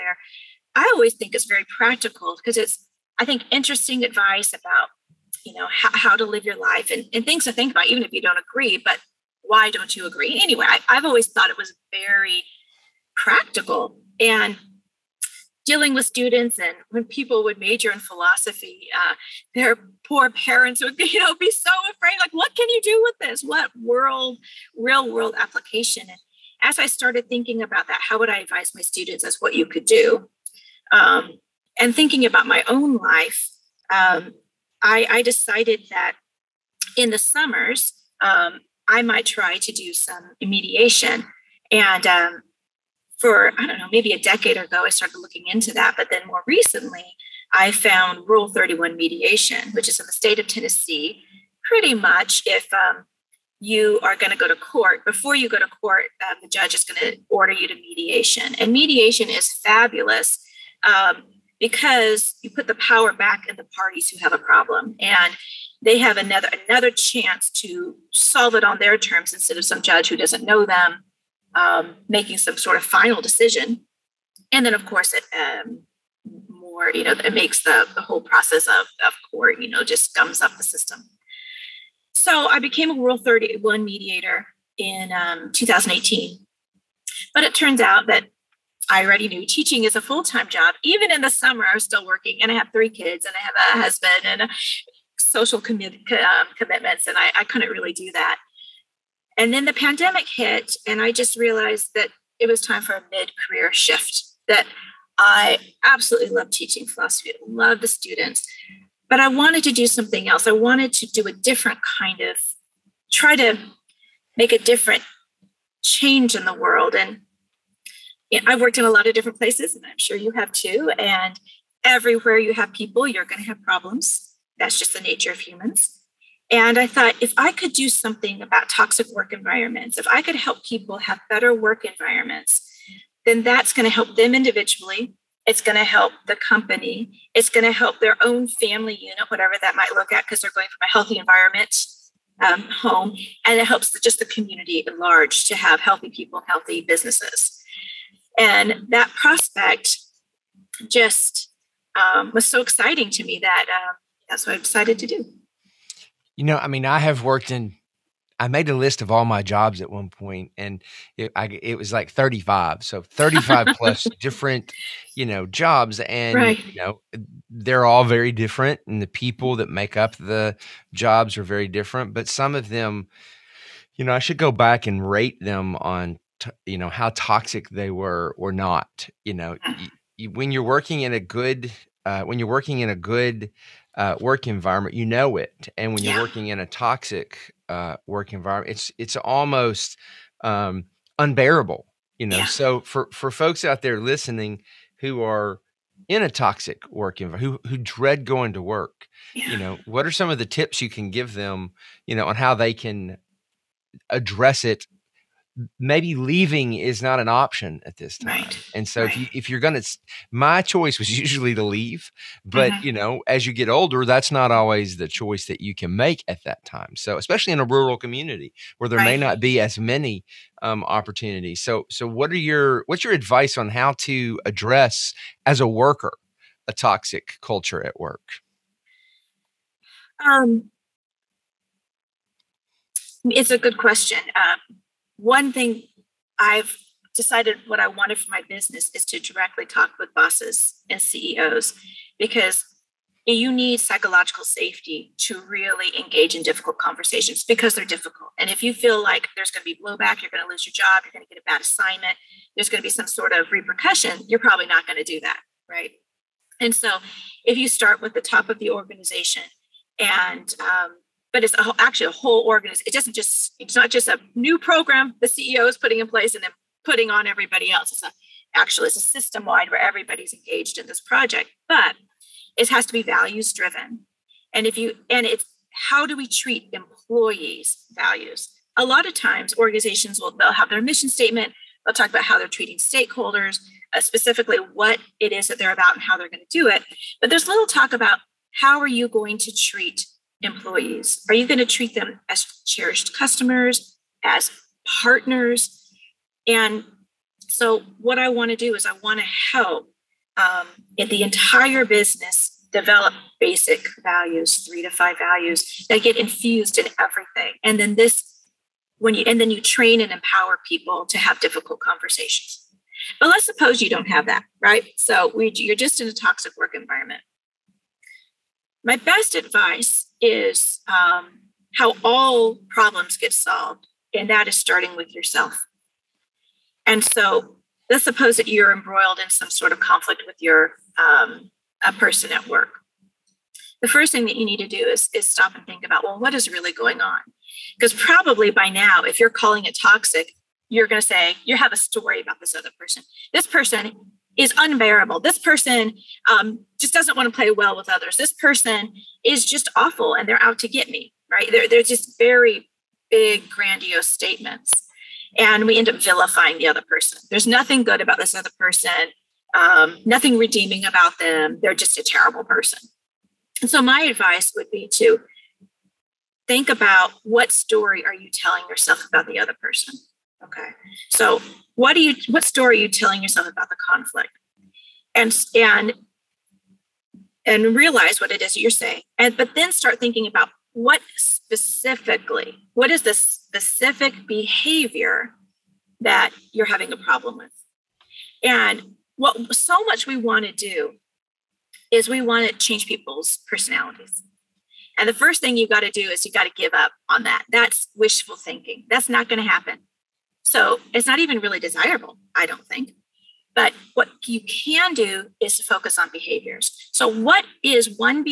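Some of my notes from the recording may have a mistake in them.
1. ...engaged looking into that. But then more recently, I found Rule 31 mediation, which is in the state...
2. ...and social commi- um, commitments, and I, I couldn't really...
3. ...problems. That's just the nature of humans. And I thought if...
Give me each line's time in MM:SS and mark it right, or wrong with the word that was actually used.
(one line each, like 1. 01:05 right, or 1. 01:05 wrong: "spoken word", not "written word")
1. 00:44 wrong: "started", not "engaged"
2. 01:34 right
3. 02:03 right.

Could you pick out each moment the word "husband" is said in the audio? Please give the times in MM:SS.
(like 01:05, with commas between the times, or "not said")
01:33.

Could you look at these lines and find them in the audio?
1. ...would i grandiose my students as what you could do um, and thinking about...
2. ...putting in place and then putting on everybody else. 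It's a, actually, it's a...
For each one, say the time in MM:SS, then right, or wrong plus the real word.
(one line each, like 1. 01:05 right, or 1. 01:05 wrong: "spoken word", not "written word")
1. 00:28 wrong: "advise", not "grandiose"
2. 04:25 right.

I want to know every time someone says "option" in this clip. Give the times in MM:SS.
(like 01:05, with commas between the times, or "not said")
03:27.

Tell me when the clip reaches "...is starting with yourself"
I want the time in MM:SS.
05:24.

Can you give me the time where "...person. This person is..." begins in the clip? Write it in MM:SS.
05:42.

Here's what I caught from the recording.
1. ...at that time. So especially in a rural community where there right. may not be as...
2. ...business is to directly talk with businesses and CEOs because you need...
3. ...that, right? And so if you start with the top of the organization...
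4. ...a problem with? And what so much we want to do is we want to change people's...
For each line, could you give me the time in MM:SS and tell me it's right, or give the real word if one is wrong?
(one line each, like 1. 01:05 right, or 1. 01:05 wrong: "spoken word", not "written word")
1. 03:36 right
2. 03:58 wrong: "bosses", not "businesses"
3. 04:15 right
4. 06:26 right.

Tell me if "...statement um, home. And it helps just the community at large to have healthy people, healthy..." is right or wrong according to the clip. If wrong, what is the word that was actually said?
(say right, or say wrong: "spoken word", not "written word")
wrong: "environment", not "statement".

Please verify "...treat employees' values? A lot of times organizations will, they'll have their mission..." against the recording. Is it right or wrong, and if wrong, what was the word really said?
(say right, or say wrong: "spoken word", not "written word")
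right.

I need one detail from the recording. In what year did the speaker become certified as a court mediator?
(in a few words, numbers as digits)
2018.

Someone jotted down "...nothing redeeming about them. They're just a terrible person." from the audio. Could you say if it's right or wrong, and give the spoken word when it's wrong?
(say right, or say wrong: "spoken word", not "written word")
right.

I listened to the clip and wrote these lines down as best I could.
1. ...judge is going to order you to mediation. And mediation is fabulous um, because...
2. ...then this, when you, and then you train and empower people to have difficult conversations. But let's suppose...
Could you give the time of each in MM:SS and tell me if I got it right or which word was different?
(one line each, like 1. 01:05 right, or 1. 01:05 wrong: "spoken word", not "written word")
1. 00:56 right
2. 05:07 right.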